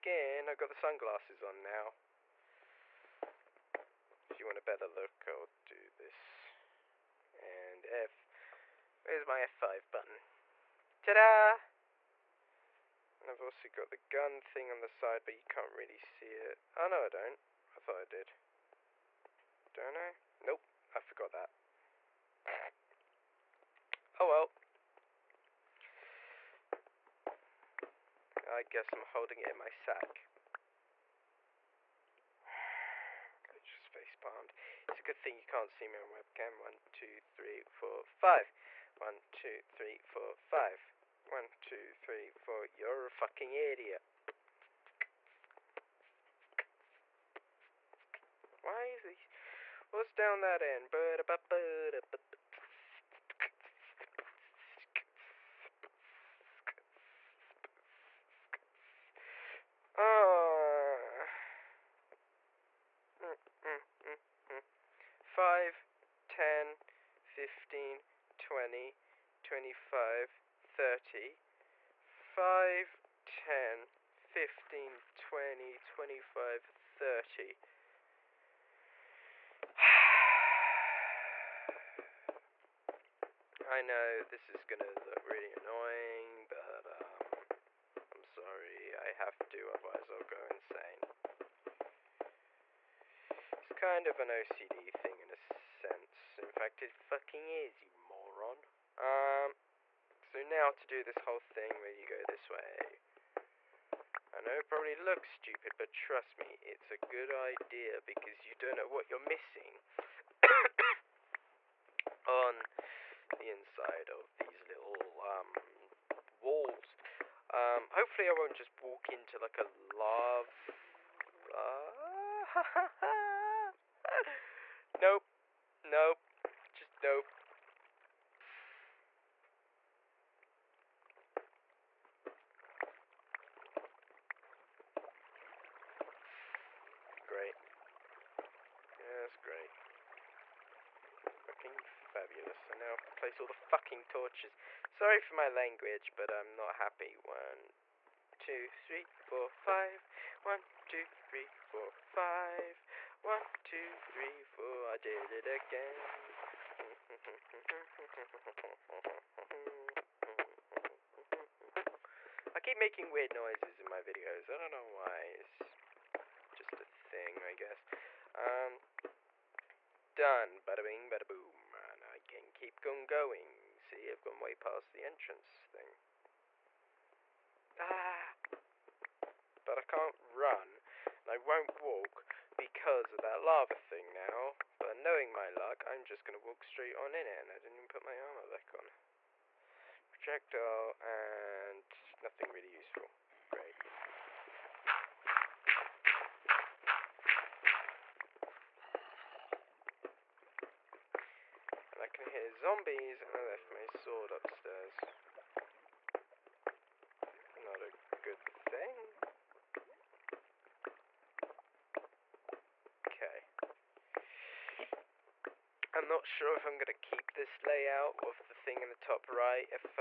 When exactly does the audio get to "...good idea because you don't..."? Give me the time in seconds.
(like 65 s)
106 s.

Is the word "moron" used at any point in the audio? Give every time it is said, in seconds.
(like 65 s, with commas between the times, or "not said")
98 s.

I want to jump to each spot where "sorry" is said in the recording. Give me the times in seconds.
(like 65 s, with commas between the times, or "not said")
88 s, 144 s.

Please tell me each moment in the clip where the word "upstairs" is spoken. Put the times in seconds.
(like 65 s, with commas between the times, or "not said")
204 s.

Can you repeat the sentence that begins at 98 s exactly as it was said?
Um, so now to do this whole thing where you go this way.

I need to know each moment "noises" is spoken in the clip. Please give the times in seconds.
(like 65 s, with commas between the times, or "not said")
163 s.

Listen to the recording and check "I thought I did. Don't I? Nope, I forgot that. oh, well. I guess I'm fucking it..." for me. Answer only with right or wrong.
wrong.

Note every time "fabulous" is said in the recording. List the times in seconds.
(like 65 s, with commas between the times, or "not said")
142 s.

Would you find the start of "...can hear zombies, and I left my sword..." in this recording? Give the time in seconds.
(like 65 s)
202 s.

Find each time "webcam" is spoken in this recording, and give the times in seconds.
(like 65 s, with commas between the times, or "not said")
36 s.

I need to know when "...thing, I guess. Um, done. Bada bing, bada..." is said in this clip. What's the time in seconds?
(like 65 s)
166 s.